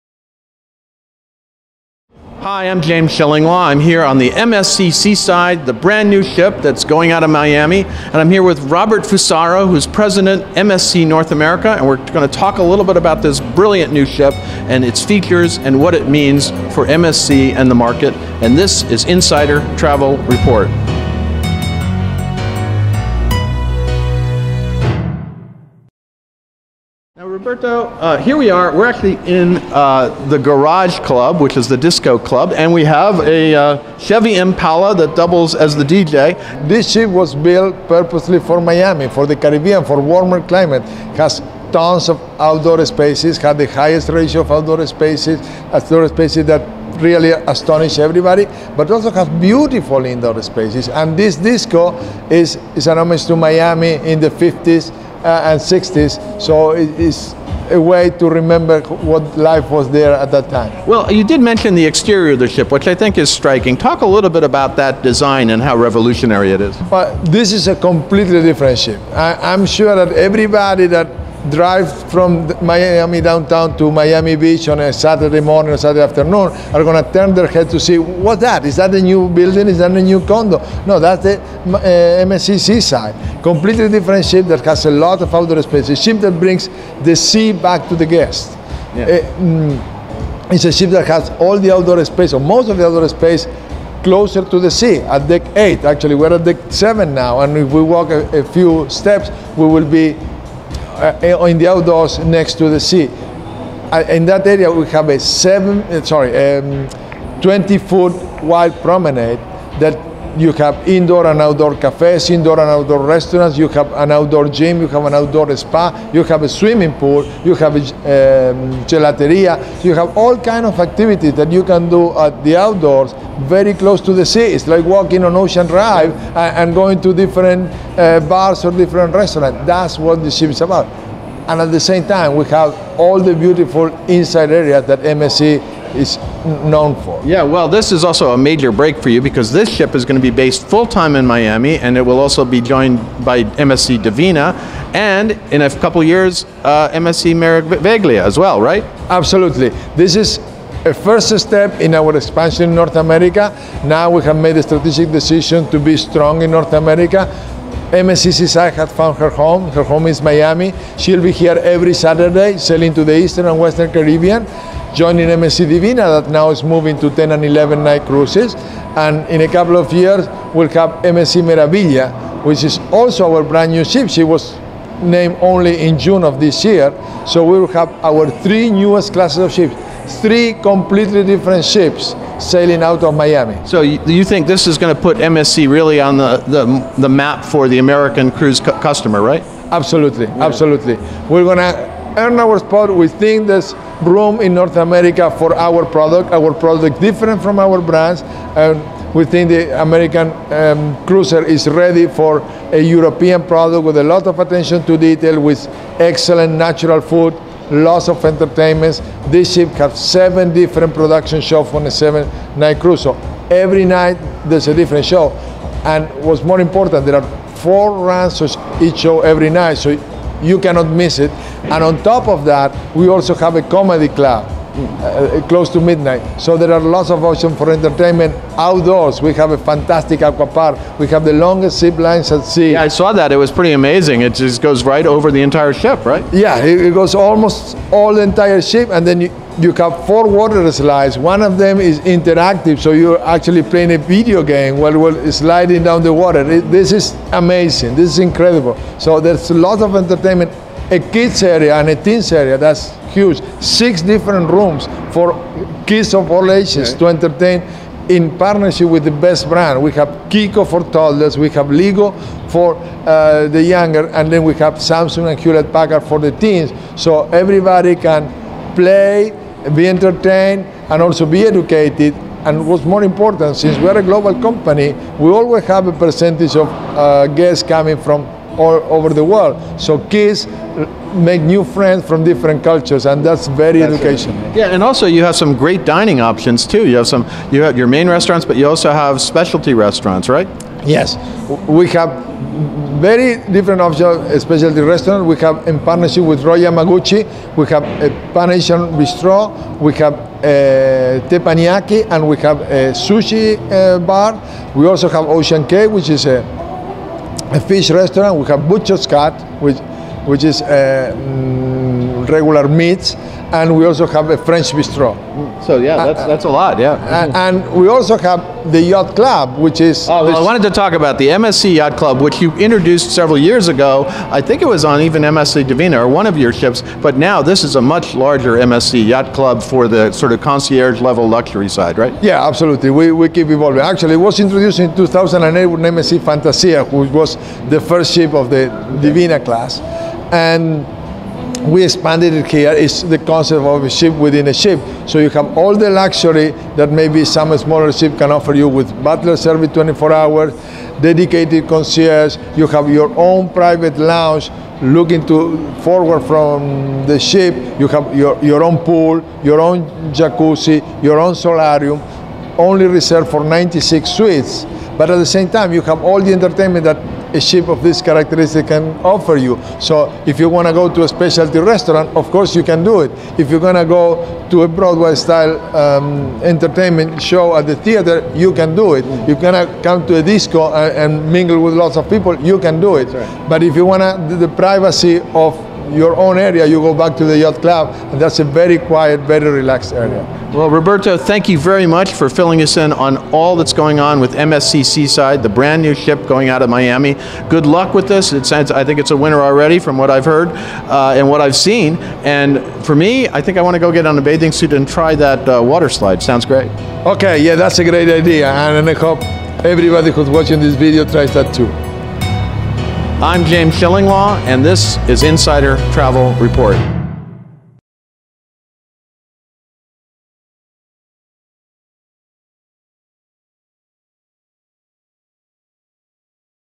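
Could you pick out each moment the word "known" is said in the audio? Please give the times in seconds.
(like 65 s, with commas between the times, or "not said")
136 s.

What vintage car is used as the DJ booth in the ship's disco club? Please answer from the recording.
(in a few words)
Chevy Impala.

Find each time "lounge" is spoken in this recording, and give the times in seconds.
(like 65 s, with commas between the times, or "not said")
353 s.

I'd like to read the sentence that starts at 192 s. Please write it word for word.
We think there's room in North America for our product.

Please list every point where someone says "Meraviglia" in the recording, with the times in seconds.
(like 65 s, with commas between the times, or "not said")
147 s, 171 s.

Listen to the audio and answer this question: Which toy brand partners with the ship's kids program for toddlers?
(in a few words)
Chicco.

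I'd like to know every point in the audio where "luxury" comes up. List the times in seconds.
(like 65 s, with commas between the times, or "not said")
331 s, 345 s.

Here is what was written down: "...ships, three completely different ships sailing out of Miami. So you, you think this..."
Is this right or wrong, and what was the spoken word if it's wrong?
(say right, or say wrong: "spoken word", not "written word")
right.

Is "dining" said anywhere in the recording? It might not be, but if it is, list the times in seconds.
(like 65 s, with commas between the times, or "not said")
285 s.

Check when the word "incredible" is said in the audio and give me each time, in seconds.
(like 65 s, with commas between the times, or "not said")
248 s.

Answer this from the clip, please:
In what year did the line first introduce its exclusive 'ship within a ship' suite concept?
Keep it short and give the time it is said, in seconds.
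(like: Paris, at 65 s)
2008, at 334 s.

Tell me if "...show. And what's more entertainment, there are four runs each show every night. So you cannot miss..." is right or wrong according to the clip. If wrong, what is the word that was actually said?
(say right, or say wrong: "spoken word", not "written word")
wrong: "important", not "entertainment".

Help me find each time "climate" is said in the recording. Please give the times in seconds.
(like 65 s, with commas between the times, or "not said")
40 s.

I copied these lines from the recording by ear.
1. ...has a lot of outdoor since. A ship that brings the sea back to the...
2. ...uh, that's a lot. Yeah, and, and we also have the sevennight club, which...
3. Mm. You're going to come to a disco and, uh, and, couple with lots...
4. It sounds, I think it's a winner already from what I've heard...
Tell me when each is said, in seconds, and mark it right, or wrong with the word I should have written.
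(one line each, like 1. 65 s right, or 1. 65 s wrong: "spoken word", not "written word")
1. 84 s wrong: "space", not "since"
2. 316 s wrong: "yacht", not "sevennight"
3. 379 s wrong: "mingle", not "couple"
4. 398 s right.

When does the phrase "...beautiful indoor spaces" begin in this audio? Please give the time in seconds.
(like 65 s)
49 s.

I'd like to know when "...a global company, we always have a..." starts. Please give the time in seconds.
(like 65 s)
273 s.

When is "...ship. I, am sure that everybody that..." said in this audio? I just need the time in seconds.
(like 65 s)
68 s.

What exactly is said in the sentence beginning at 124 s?
It's like walking on Ocean Drive and, going to different uh, bars or different restaurants.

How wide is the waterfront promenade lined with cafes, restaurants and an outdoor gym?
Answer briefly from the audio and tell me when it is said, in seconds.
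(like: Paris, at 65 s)
20 feet, at 107 s.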